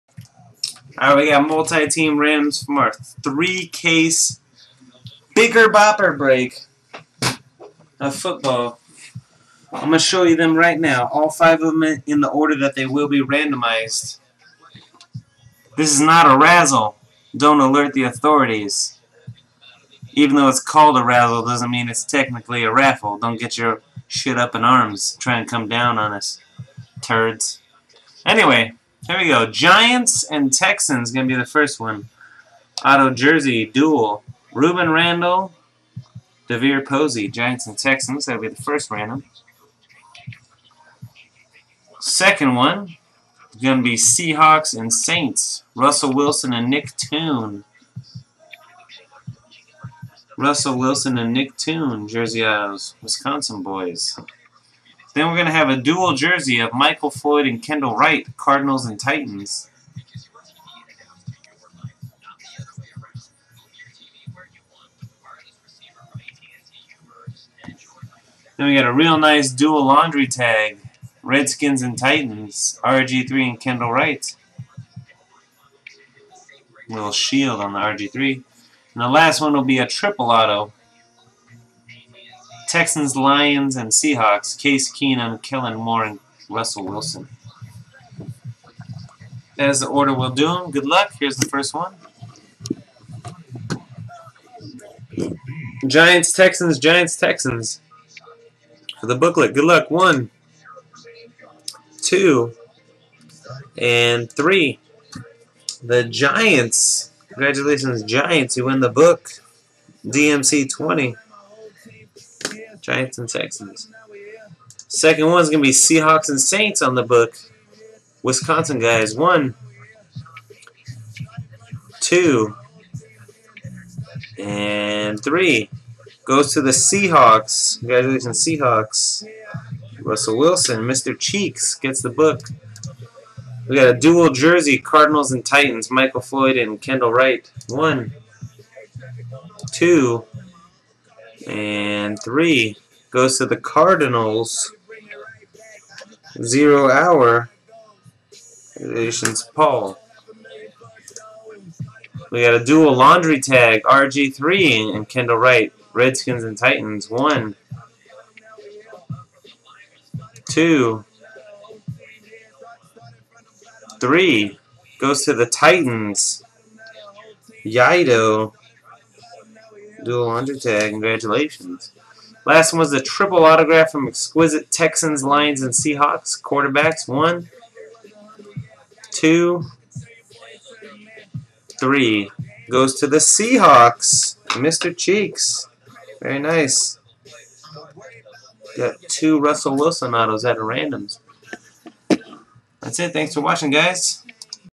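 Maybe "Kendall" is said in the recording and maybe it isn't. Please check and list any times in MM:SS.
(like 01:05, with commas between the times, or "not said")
00:57, 01:13, 02:16, 02:35.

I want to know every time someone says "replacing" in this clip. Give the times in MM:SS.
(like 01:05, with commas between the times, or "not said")
not said.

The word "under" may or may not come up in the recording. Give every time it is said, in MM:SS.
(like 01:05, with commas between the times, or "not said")
02:50.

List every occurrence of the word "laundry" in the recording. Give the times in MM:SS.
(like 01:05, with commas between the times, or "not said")
01:09, 02:32.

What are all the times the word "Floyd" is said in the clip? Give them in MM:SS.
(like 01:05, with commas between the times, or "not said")
00:57, 02:16.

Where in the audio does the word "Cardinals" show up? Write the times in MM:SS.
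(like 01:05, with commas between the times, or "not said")
00:58, 02:14, 02:23.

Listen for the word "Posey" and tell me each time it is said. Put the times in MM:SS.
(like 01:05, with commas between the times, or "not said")
00:36.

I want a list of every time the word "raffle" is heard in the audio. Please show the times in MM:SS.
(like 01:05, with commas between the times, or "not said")
00:22.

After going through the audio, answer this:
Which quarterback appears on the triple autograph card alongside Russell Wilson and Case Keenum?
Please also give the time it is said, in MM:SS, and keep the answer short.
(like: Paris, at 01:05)
Kellen Moore, at 01:25.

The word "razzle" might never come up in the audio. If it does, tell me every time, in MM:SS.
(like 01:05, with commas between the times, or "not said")
00:16, 00:21.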